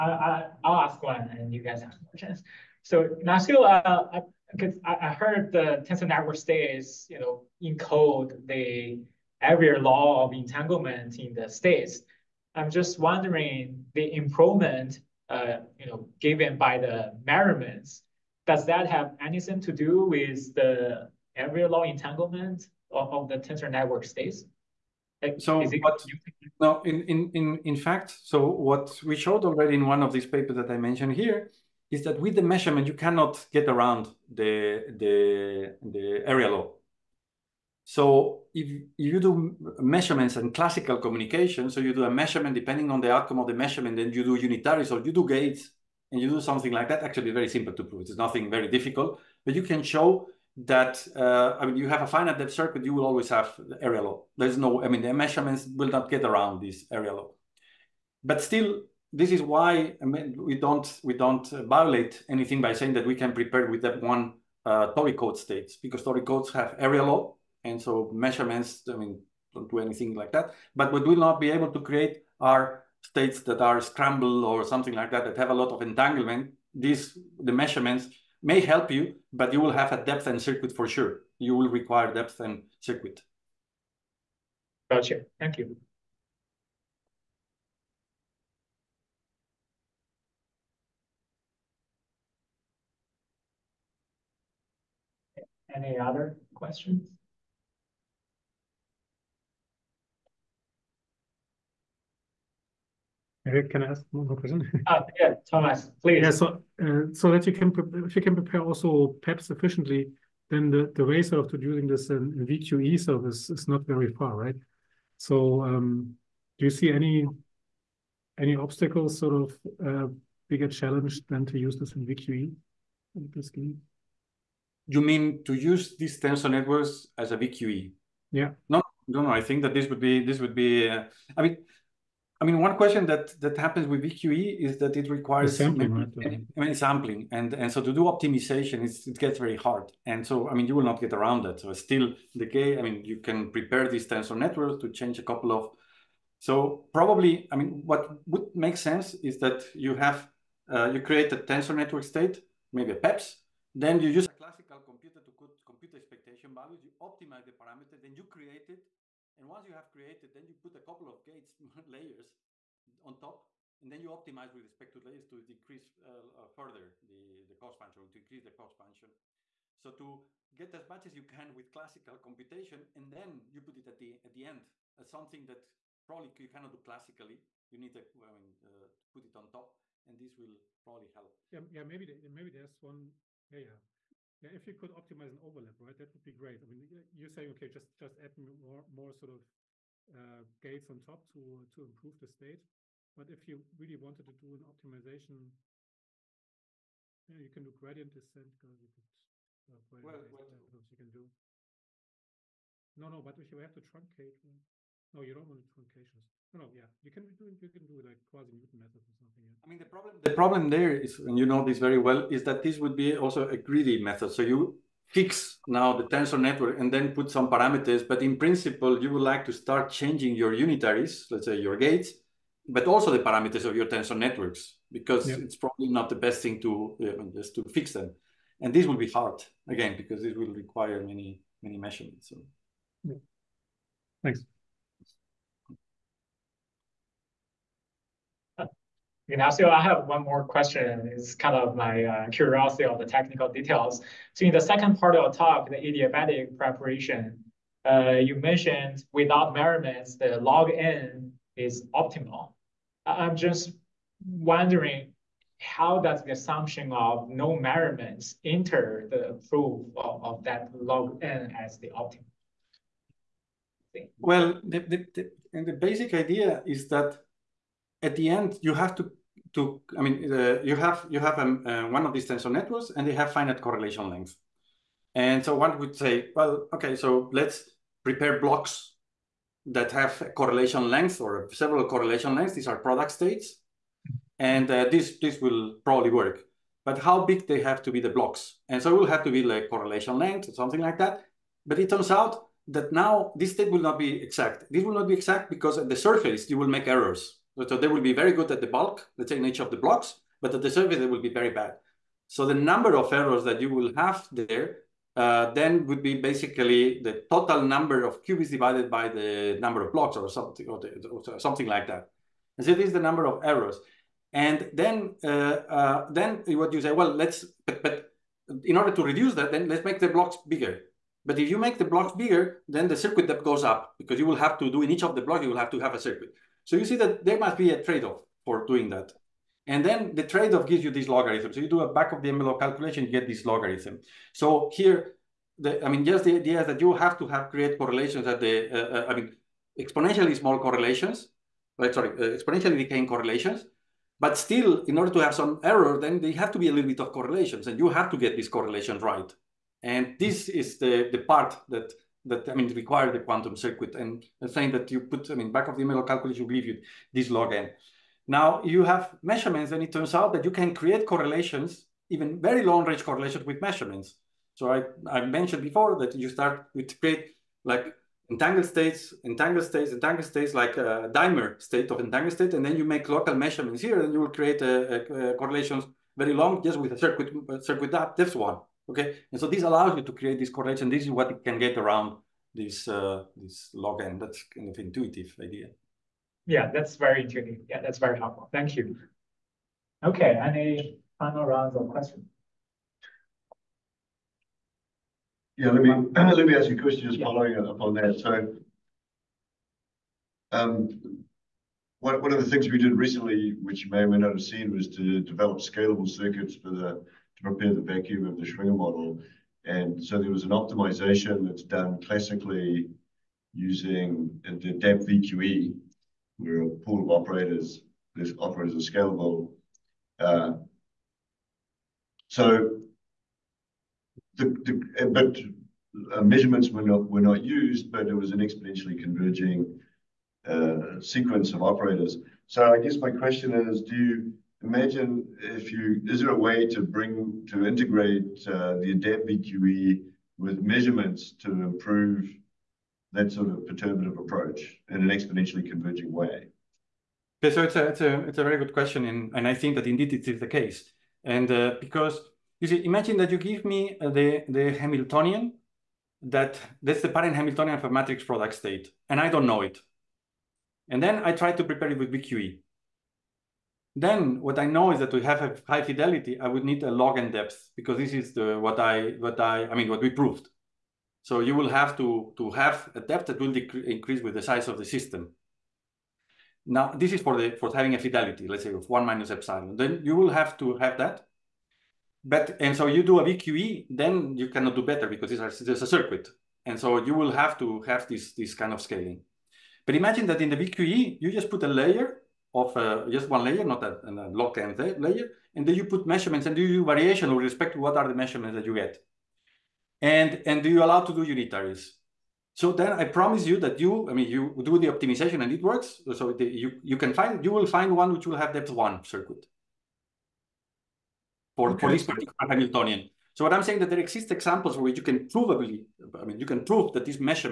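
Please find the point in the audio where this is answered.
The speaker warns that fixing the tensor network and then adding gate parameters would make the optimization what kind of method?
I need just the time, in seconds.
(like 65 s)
213 s.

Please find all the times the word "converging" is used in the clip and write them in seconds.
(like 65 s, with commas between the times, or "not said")
429 s, 445 s.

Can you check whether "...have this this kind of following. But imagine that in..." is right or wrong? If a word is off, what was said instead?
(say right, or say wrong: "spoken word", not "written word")
wrong: "scaling", not "following".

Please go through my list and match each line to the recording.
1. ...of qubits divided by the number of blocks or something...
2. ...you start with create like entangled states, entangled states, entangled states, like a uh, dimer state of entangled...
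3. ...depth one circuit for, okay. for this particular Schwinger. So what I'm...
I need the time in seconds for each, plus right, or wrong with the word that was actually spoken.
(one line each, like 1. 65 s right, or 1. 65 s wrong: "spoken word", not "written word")
1. 308 s right
2. 366 s right
3. 508 s wrong: "Hamiltonian", not "Schwinger".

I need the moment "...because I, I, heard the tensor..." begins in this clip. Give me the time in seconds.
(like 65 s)
4 s.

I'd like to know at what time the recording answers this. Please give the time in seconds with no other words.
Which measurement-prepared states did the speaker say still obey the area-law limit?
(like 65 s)
64 s.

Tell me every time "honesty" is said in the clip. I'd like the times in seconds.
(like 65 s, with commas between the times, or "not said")
not said.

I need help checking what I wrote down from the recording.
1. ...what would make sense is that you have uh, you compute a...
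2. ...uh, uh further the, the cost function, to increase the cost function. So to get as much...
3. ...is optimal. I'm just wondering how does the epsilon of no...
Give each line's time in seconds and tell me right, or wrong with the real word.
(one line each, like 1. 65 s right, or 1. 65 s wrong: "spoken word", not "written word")
1. 147 s wrong: "create", not "compute"
2. 166 s right
3. 251 s wrong: "assumption", not "epsilon".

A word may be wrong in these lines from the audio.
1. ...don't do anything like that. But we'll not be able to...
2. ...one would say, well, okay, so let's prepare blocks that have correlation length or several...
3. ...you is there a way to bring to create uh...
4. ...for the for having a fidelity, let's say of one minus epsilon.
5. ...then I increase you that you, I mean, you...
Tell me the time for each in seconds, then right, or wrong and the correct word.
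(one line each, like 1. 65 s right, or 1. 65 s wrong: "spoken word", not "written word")
1. 69 s right
2. 275 s right
3. 435 s wrong: "integrate", not "create"
4. 477 s right
5. 502 s wrong: "promise", not "increase".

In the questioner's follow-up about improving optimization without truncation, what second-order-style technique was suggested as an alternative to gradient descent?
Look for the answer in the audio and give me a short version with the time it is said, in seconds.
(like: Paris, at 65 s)
quasi Newton method, at 208 s.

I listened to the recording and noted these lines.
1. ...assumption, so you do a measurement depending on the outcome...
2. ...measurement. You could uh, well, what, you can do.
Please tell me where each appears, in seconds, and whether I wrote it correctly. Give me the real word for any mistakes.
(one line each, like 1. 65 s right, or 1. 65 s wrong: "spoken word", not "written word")
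1. 40 s wrong: "communication", not "assumption"
2. 198 s wrong: "descent", not "measurement".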